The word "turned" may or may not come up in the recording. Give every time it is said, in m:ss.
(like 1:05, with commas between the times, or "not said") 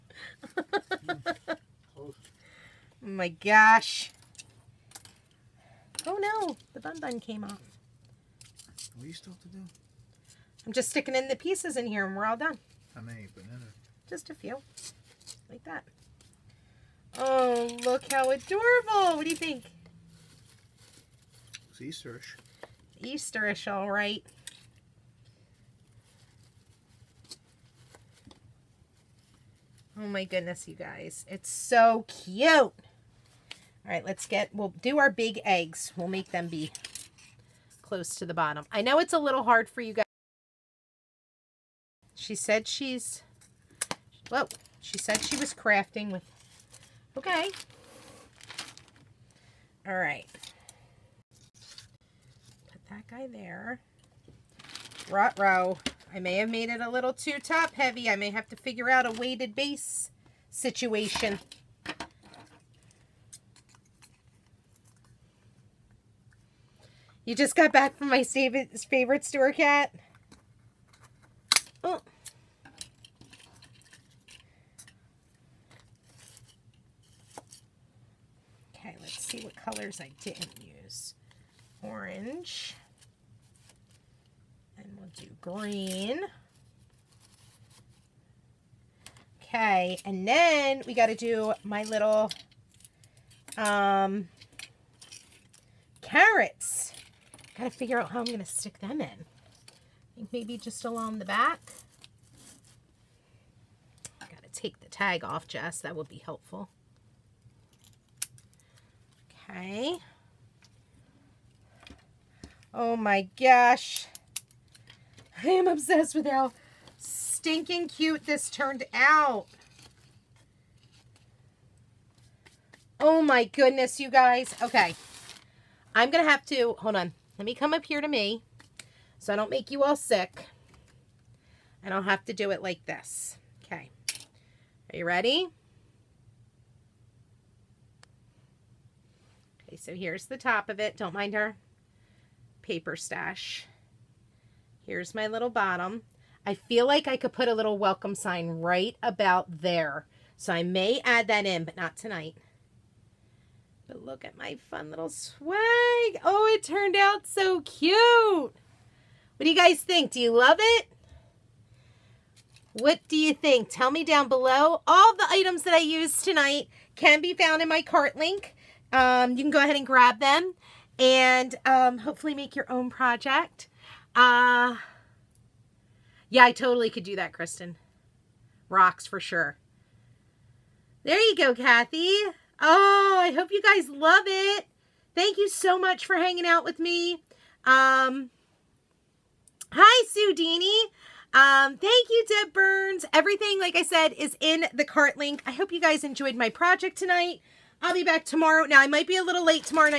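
1:58, 2:36.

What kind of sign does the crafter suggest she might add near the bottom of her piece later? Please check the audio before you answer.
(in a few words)
welcome sign.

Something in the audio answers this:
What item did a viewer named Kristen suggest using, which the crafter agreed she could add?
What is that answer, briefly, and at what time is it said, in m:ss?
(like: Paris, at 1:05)
Rocks, at 2:58.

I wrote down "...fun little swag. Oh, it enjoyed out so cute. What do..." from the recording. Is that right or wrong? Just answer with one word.
wrong.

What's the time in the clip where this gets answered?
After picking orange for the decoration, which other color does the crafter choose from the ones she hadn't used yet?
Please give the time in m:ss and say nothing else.
1:25.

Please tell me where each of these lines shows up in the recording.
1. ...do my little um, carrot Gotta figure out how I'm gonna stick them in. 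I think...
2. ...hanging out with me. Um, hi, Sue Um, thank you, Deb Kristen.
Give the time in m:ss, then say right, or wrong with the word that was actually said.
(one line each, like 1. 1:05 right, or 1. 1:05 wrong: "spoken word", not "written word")
1. 1:31 right
2. 3:06 wrong: "Burns", not "Kristen".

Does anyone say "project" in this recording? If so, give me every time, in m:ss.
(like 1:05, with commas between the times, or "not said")
2:52, 3:16.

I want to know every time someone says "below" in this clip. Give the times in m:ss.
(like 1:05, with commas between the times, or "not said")
2:44.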